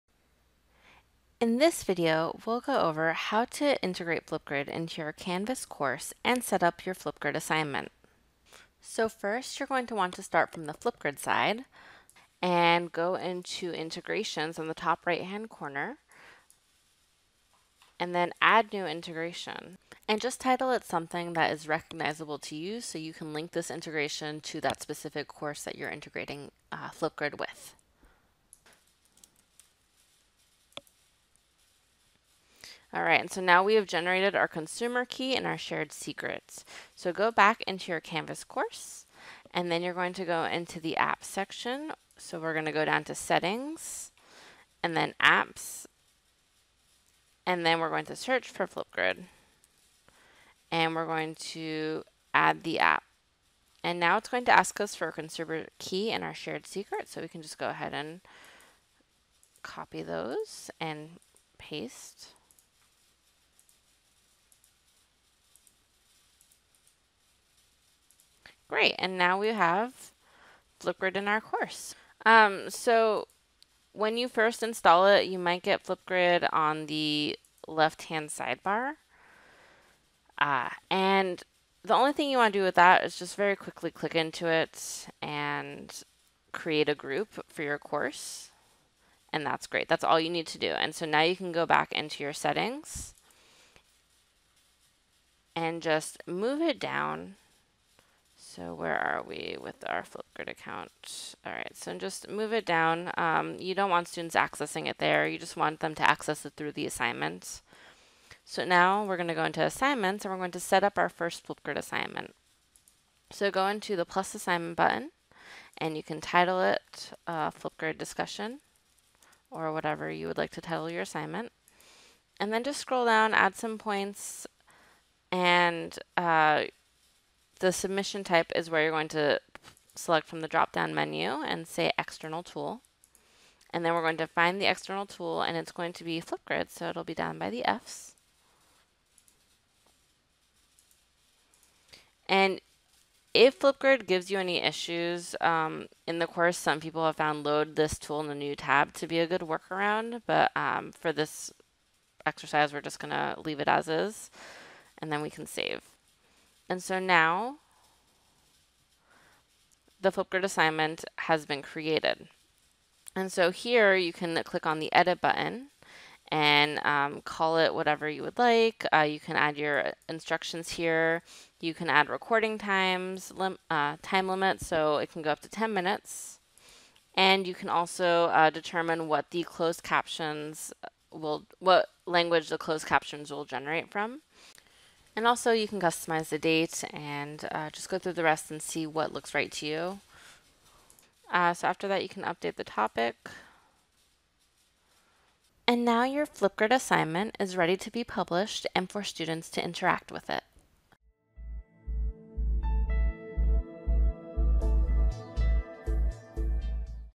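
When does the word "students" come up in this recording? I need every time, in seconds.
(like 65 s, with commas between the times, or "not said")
104 s, 199 s.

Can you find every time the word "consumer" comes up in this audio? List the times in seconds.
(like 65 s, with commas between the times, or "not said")
34 s, 55 s.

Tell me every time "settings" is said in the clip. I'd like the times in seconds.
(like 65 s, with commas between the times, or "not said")
43 s, 92 s.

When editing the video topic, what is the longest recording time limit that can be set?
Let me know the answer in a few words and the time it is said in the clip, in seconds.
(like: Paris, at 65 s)
10 minutes, at 175 s.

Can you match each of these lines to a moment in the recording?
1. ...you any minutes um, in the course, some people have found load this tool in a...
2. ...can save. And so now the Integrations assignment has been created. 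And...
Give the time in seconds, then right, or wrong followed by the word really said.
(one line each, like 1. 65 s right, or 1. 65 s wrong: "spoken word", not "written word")
1. 144 s wrong: "issues", not "minutes"
2. 155 s wrong: "Flipgrid", not "Integrations".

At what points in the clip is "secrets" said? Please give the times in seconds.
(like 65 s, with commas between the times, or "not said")
35 s, 56 s.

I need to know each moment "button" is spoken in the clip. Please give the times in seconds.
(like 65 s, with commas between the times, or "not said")
114 s, 165 s.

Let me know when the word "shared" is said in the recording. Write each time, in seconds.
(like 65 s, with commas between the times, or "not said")
35 s, 56 s.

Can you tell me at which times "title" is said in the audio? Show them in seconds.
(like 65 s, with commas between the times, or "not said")
20 s, 116 s, 120 s.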